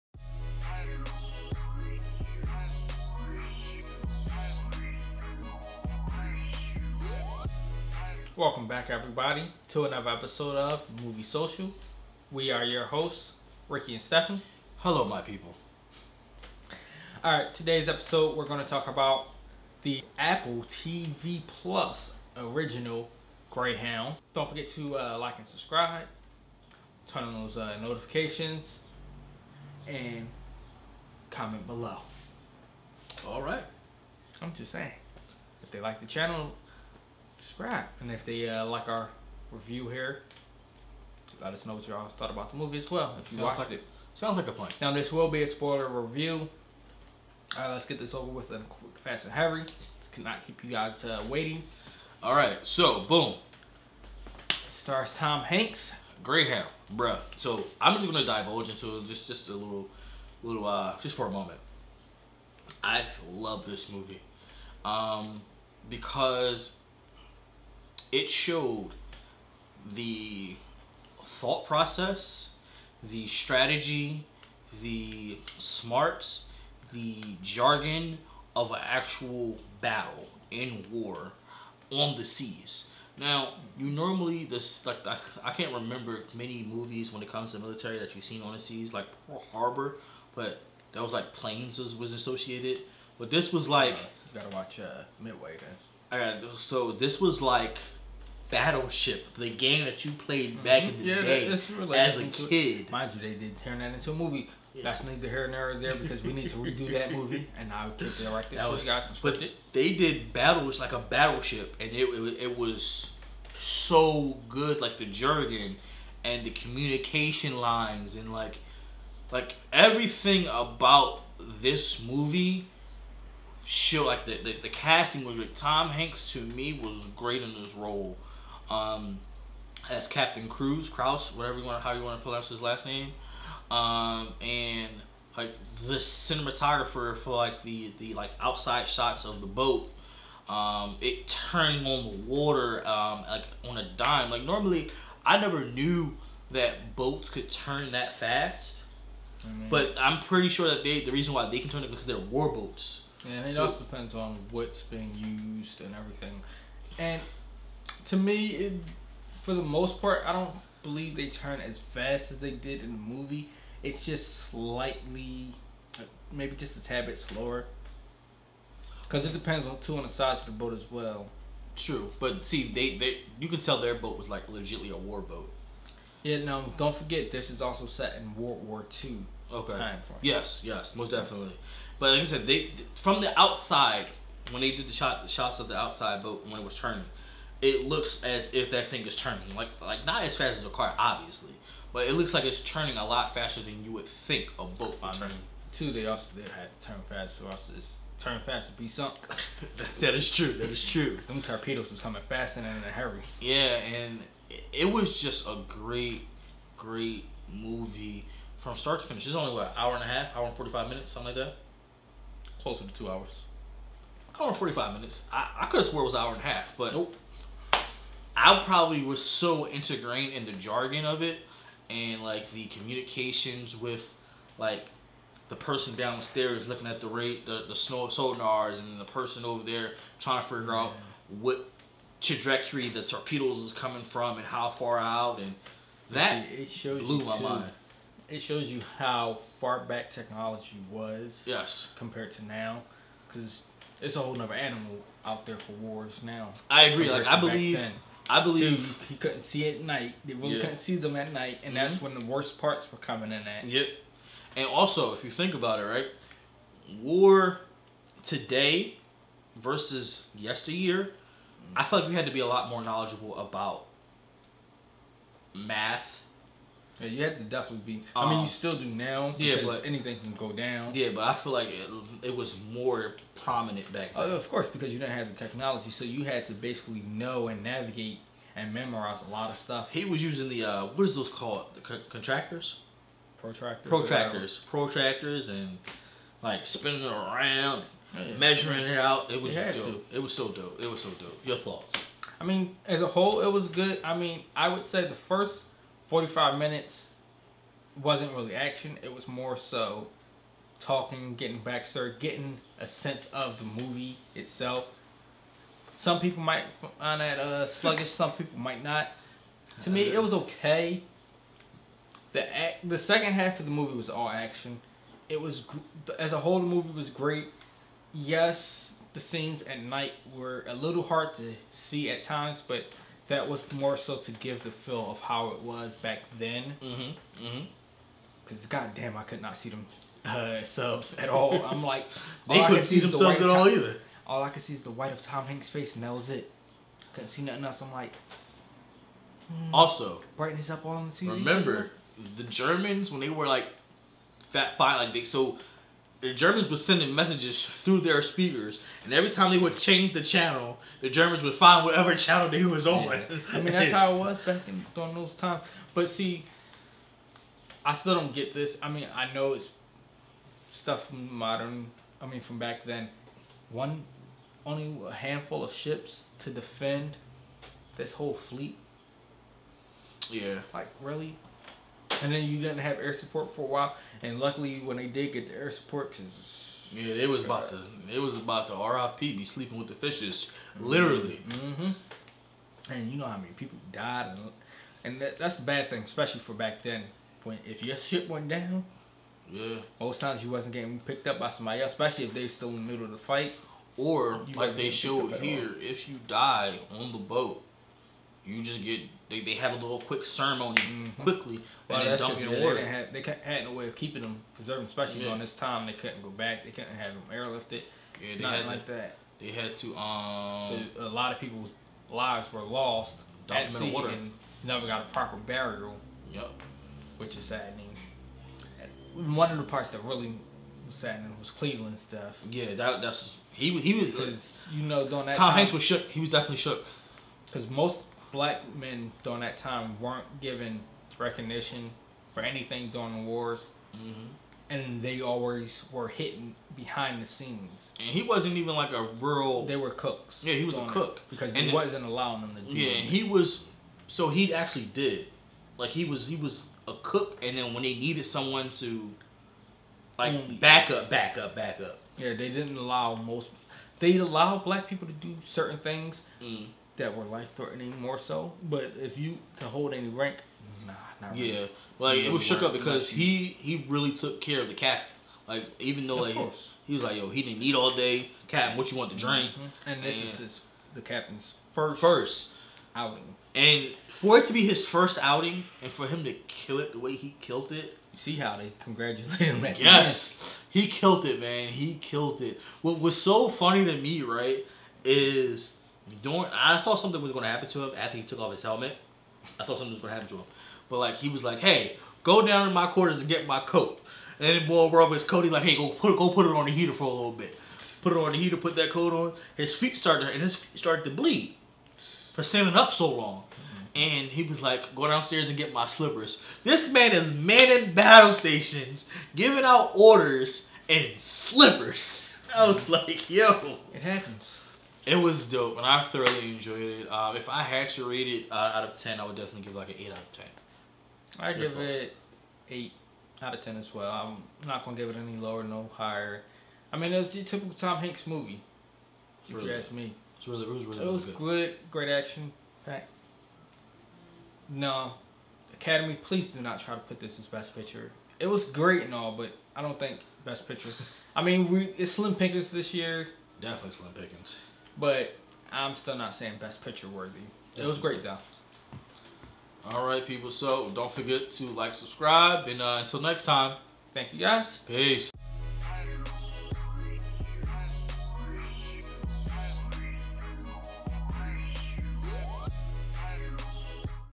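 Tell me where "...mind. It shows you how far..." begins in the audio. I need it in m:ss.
3:57.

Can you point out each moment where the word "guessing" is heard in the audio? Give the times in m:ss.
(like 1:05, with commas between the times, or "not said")
not said.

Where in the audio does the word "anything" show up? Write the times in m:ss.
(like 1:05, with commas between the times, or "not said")
4:29, 7:12.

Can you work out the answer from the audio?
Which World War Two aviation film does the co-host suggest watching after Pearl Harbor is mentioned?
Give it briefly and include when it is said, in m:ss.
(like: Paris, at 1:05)
Midway, at 1:35.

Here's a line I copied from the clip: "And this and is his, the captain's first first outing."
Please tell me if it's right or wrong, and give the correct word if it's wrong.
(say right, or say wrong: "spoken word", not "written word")
right.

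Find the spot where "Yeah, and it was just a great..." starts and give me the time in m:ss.
3:23.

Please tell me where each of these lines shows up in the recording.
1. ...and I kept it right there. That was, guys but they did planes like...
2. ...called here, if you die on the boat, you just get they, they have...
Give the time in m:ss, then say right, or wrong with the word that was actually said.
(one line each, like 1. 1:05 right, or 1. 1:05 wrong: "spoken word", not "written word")
1. 1:47 wrong: "battles", not "planes"
2. 6:34 wrong: "showed", not "called".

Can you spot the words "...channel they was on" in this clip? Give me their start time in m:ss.
5:52.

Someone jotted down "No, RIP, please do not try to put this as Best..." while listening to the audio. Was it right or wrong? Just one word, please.
wrong.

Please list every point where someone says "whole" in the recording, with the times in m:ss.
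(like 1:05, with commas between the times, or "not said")
4:04, 4:53, 5:16, 6:08.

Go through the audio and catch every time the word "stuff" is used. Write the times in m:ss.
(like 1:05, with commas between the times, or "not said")
4:39, 6:00, 7:01.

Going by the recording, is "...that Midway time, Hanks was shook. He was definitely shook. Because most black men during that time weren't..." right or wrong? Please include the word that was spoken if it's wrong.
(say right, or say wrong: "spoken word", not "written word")
wrong: "Tom", not "Midway".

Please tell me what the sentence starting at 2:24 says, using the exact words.
Like normally, I never knew that boats could turn that fast.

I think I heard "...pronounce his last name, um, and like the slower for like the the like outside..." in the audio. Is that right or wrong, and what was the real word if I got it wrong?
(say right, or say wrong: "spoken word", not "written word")
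wrong: "cinematographer", not "slower".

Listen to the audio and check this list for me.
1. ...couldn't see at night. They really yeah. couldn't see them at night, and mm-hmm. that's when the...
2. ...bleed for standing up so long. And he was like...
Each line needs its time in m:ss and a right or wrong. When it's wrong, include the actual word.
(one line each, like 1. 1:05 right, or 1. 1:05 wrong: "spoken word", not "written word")
1. 4:09 right
2. 8:21 right.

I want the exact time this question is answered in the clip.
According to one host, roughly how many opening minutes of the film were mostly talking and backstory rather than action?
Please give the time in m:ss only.
4:55.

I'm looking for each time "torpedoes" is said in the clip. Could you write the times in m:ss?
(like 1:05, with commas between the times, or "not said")
3:21, 3:53.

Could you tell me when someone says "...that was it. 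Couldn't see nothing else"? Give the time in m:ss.
5:36.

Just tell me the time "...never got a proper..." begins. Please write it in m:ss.
6:54.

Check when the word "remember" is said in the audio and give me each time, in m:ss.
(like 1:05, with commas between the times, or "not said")
1:25, 5:41.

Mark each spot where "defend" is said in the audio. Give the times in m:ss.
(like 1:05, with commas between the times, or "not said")
6:06.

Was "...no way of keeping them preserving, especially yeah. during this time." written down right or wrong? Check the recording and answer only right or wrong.
right.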